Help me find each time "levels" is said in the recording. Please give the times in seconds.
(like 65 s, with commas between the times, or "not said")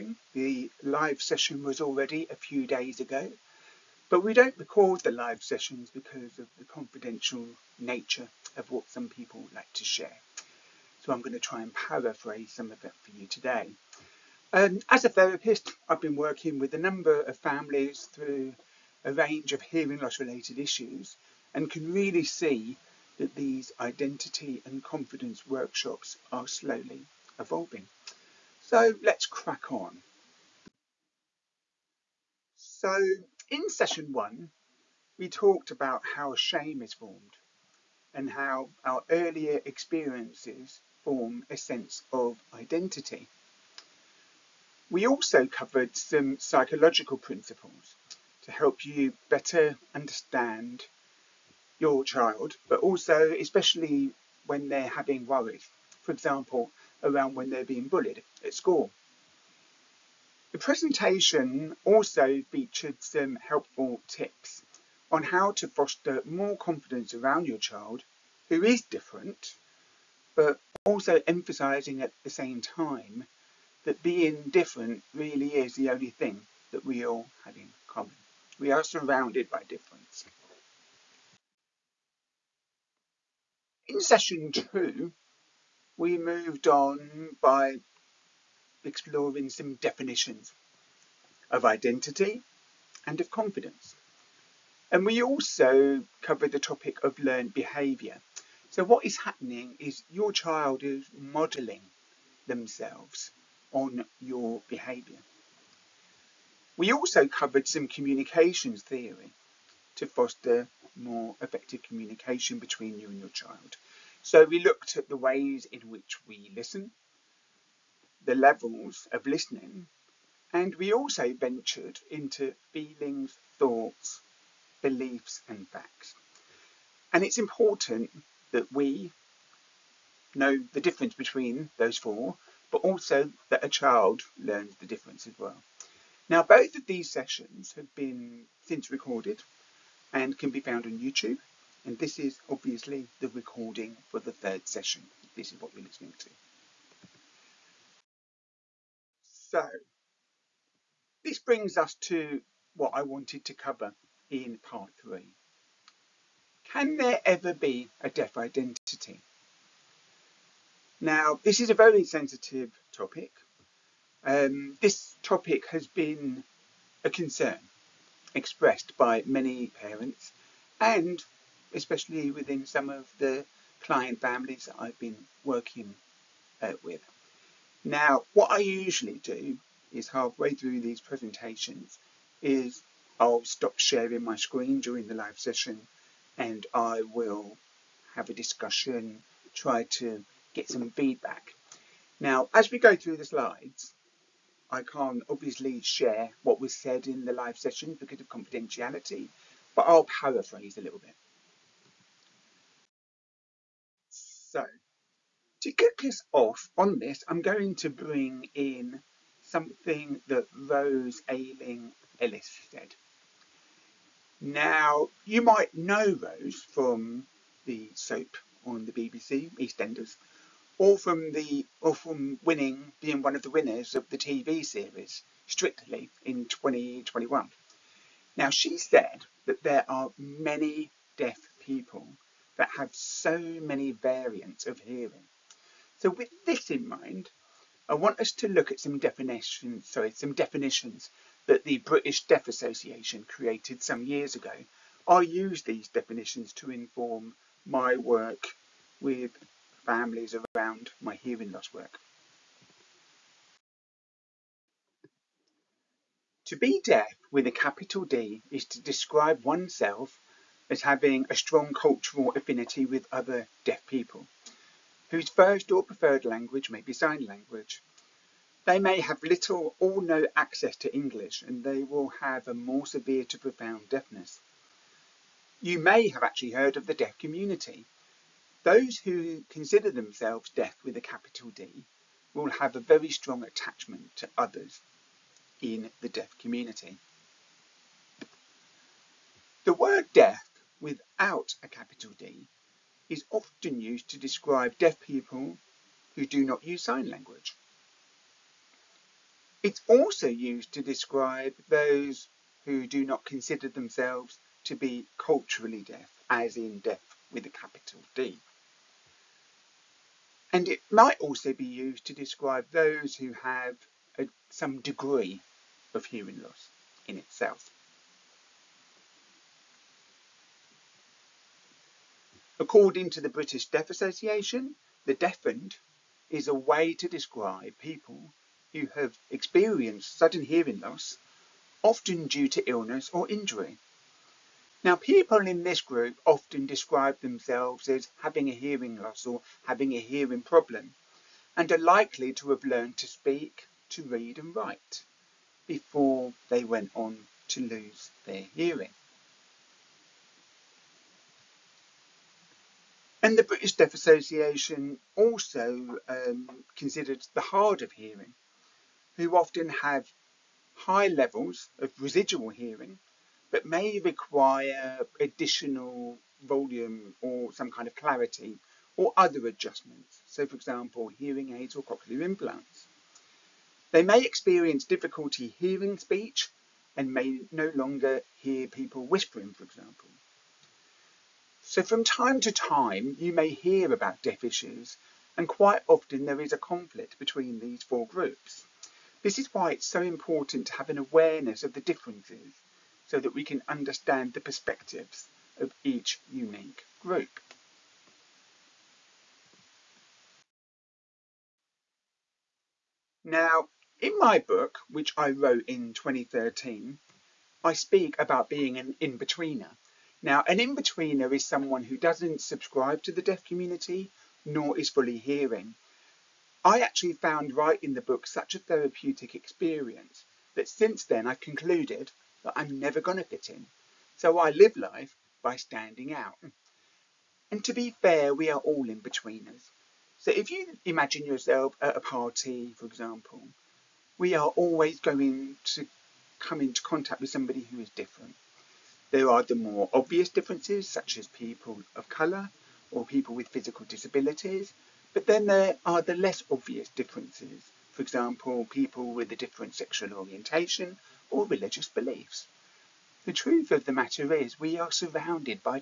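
118 s, 361 s.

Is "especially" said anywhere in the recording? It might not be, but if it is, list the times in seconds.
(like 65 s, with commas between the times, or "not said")
53 s, 171 s.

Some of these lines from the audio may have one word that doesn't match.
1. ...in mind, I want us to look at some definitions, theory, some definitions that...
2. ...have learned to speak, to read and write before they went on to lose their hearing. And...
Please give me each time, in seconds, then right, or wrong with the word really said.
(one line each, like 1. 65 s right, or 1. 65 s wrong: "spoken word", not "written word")
1. 236 s wrong: "sorry", not "theory"
2. 342 s right.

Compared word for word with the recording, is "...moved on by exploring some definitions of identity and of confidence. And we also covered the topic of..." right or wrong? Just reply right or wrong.
right.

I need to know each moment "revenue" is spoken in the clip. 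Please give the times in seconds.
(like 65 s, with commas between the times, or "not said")
not said.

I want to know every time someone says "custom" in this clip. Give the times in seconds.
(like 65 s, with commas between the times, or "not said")
not said.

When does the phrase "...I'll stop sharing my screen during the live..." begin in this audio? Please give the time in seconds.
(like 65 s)
183 s.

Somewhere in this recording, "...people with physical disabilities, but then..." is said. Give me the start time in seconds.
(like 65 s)
443 s.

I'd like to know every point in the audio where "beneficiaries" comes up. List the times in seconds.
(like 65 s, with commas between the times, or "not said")
not said.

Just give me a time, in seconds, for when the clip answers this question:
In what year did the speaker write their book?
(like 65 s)
405 s.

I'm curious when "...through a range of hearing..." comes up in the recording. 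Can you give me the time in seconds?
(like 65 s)
18 s.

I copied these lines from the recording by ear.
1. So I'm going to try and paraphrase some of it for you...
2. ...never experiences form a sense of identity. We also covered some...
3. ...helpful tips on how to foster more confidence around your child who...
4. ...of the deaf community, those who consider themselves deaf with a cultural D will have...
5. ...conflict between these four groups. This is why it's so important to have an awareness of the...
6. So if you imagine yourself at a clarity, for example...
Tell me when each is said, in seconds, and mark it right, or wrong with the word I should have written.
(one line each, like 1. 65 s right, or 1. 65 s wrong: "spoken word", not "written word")
1. 11 s right
2. 39 s wrong: "earlier", not "never"
3. 63 s right
4. 276 s wrong: "capital", not "cultural"
5. 386 s right
6. 430 s wrong: "party", not "clarity".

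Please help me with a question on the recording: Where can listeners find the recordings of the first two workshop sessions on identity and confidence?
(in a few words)
YouTube.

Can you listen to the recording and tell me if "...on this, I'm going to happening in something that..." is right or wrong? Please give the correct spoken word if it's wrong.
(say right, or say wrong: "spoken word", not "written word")
wrong: "bring", not "happening".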